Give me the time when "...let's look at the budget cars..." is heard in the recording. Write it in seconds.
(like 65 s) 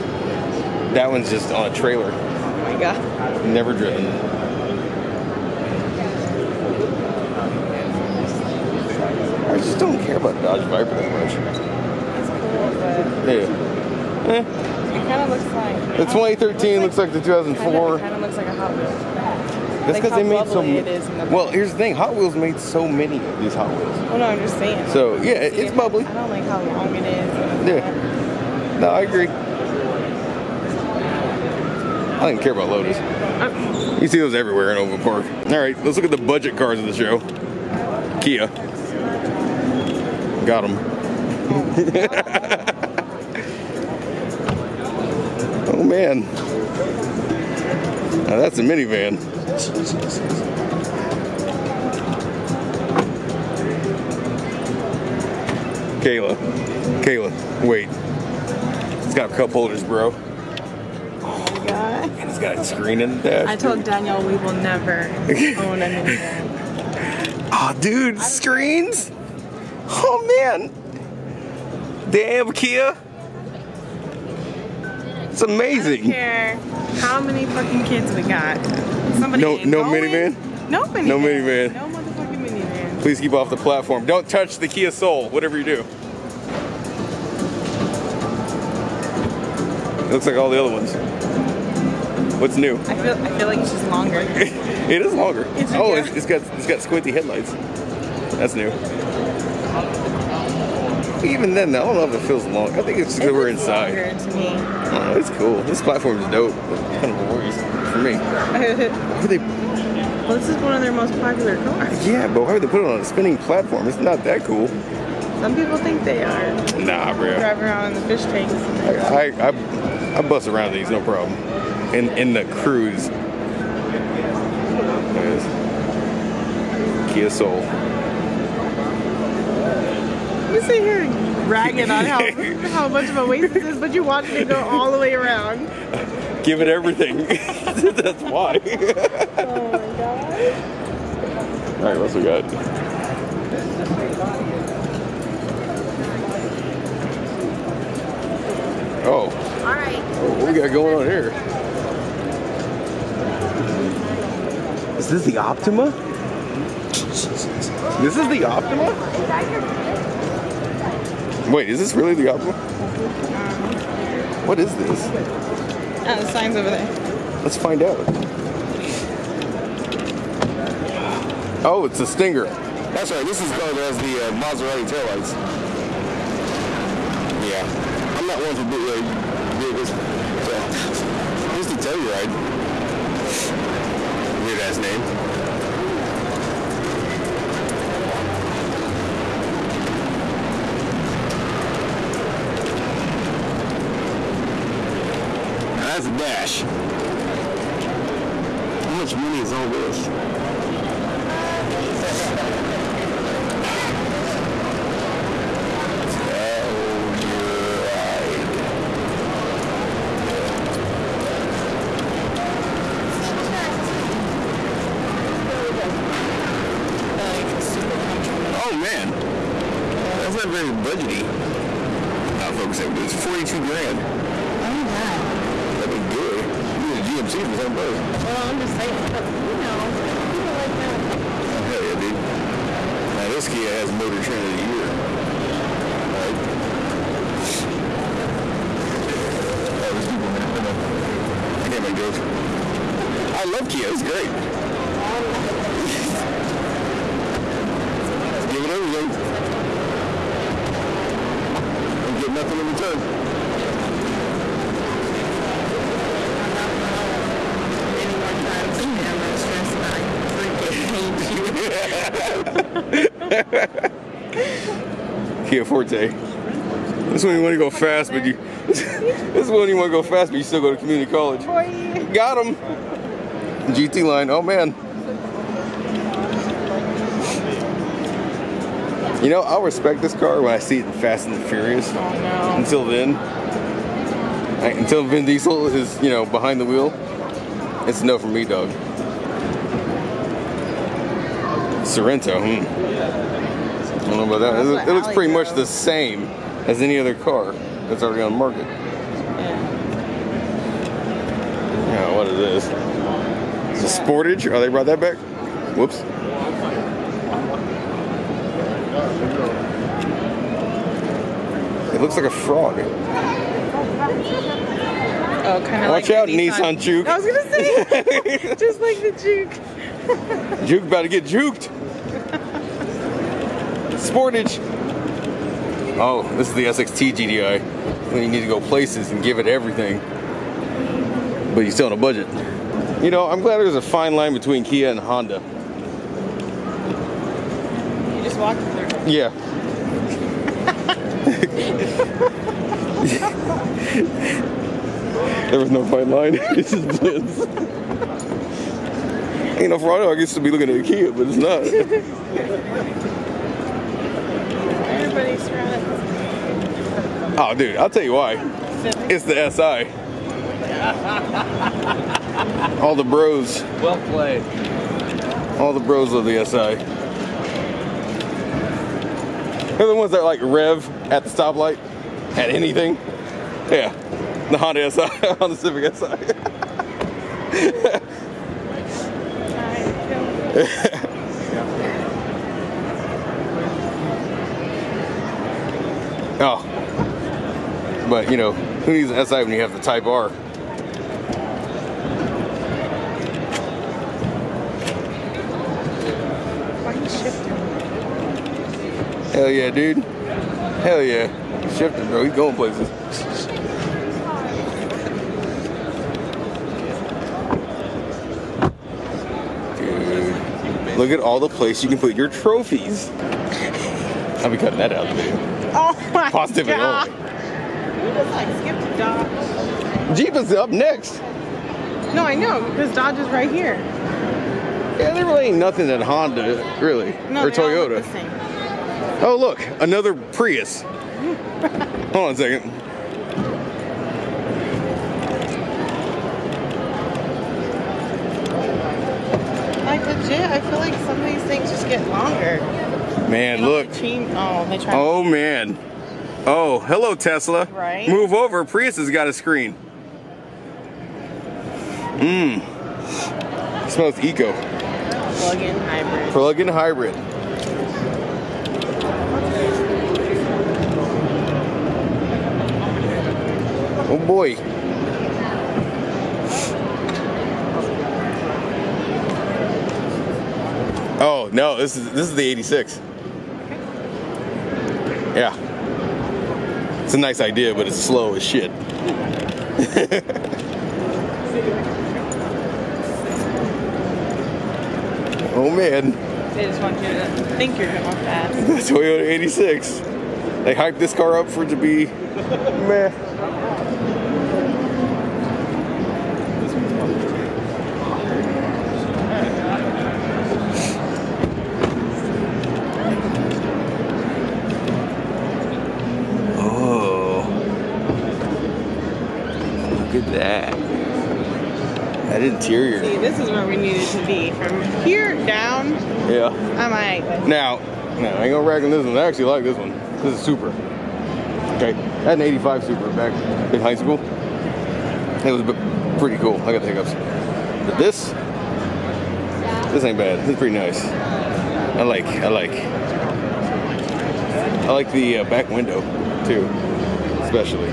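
35 s.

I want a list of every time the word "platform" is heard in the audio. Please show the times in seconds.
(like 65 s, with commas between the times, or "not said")
83 s, 105 s, 113 s.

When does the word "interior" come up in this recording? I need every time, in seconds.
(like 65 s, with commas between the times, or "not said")
512 s.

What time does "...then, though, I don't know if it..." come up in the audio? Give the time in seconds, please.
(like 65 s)
101 s.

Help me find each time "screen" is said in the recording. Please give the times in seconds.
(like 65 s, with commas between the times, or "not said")
62 s, 68 s, 449 s.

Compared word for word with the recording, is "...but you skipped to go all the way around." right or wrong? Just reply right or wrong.
wrong.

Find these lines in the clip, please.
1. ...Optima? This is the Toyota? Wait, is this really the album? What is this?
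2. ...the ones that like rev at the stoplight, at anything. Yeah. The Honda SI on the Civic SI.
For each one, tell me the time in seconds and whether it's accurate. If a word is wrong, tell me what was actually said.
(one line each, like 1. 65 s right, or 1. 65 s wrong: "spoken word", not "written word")
1. 155 s wrong: "Optima", not "Toyota"
2. 369 s right.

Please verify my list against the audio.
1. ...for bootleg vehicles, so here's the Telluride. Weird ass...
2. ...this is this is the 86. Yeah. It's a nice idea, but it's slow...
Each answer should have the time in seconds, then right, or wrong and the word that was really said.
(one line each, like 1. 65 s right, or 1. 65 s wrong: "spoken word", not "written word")
1. 178 s right
2. 471 s right.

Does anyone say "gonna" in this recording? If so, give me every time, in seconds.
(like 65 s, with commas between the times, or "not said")
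259 s, 317 s, 518 s.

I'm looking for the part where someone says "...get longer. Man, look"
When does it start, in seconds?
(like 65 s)
441 s.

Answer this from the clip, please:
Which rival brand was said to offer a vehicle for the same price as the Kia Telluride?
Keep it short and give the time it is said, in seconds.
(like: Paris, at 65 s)
GMC, at 227 s.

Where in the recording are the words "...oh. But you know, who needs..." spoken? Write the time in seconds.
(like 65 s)
386 s.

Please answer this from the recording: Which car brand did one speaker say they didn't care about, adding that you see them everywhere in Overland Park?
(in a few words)
Lotus.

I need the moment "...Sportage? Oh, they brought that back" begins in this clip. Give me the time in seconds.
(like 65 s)
304 s.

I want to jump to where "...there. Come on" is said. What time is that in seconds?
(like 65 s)
240 s.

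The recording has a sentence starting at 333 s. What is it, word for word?
You know, I'm glad there's a fine line between Kia and Honda.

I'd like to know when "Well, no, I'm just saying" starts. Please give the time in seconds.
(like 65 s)
24 s.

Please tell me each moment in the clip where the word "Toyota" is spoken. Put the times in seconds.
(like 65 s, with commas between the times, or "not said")
427 s, 488 s.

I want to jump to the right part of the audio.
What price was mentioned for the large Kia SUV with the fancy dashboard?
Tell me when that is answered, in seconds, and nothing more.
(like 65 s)
223 s.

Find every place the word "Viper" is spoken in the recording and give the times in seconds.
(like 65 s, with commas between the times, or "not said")
10 s.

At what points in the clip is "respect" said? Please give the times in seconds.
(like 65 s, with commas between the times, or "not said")
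279 s.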